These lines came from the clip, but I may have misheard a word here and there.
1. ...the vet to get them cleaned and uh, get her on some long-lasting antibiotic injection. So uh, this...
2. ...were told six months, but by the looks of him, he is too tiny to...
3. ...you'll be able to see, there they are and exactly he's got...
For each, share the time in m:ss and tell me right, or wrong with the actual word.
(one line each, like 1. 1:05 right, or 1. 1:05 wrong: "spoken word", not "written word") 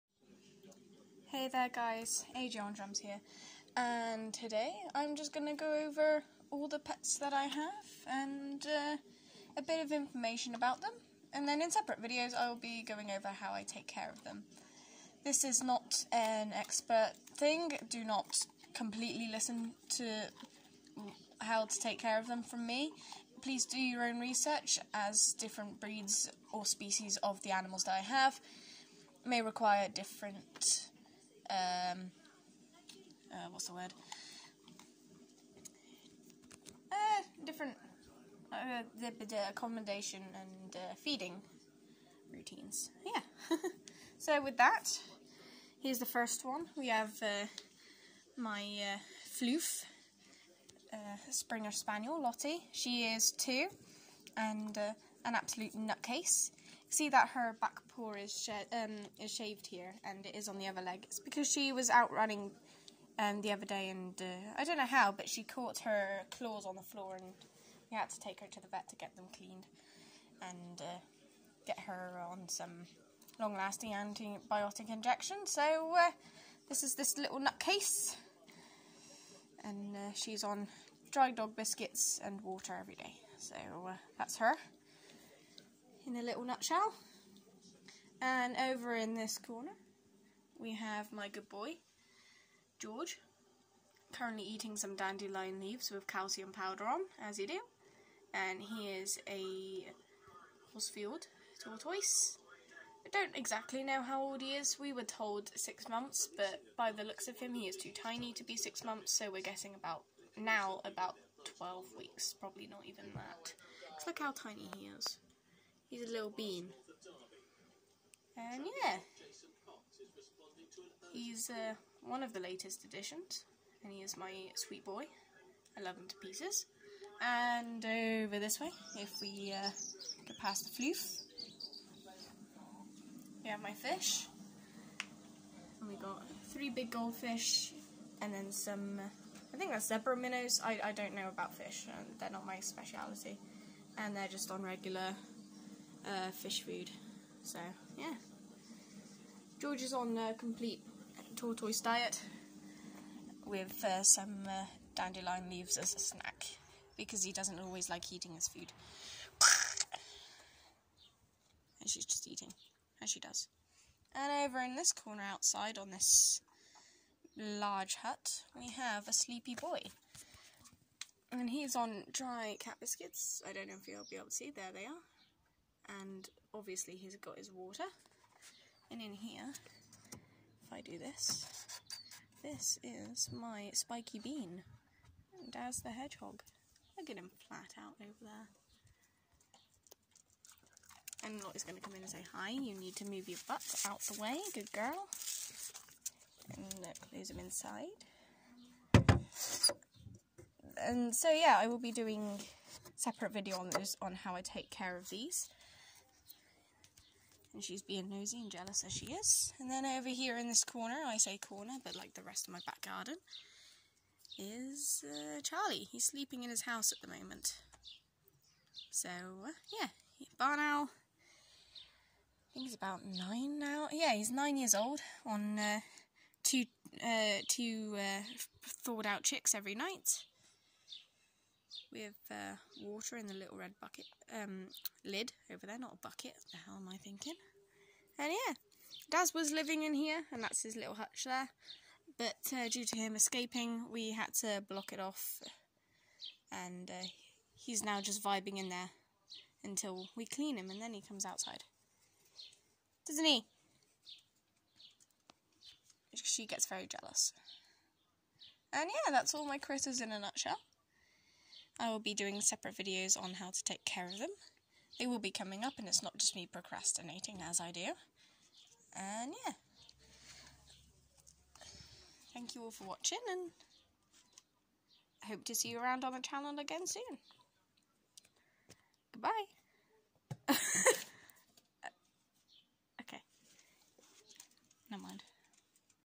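1. 1:08 right
2. 1:44 right
3. 2:53 wrong: "obviously", not "exactly".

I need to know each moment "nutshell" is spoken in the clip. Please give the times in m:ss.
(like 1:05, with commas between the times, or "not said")
1:26, 4:20.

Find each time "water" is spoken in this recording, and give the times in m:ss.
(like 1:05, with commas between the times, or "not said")
1:22, 2:57, 3:52.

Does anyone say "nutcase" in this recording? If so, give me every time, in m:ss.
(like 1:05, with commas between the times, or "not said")
0:55, 1:17.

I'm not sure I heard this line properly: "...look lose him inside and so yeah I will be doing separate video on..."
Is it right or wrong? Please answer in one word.
right.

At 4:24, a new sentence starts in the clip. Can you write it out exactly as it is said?
They will be coming up and it's not just me procrastinating as I do.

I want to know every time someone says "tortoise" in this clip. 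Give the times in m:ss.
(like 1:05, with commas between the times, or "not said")
1:41, 2:31.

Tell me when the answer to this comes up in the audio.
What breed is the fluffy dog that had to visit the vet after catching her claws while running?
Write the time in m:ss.
0:51.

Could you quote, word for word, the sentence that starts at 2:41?
and she's just eating, as she does.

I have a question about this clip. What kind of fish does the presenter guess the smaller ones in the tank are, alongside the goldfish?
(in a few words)
zebra minnows.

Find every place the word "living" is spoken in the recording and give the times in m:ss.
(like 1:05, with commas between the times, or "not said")
3:59.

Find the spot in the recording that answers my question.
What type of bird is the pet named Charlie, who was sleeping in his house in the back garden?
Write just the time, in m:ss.
3:40.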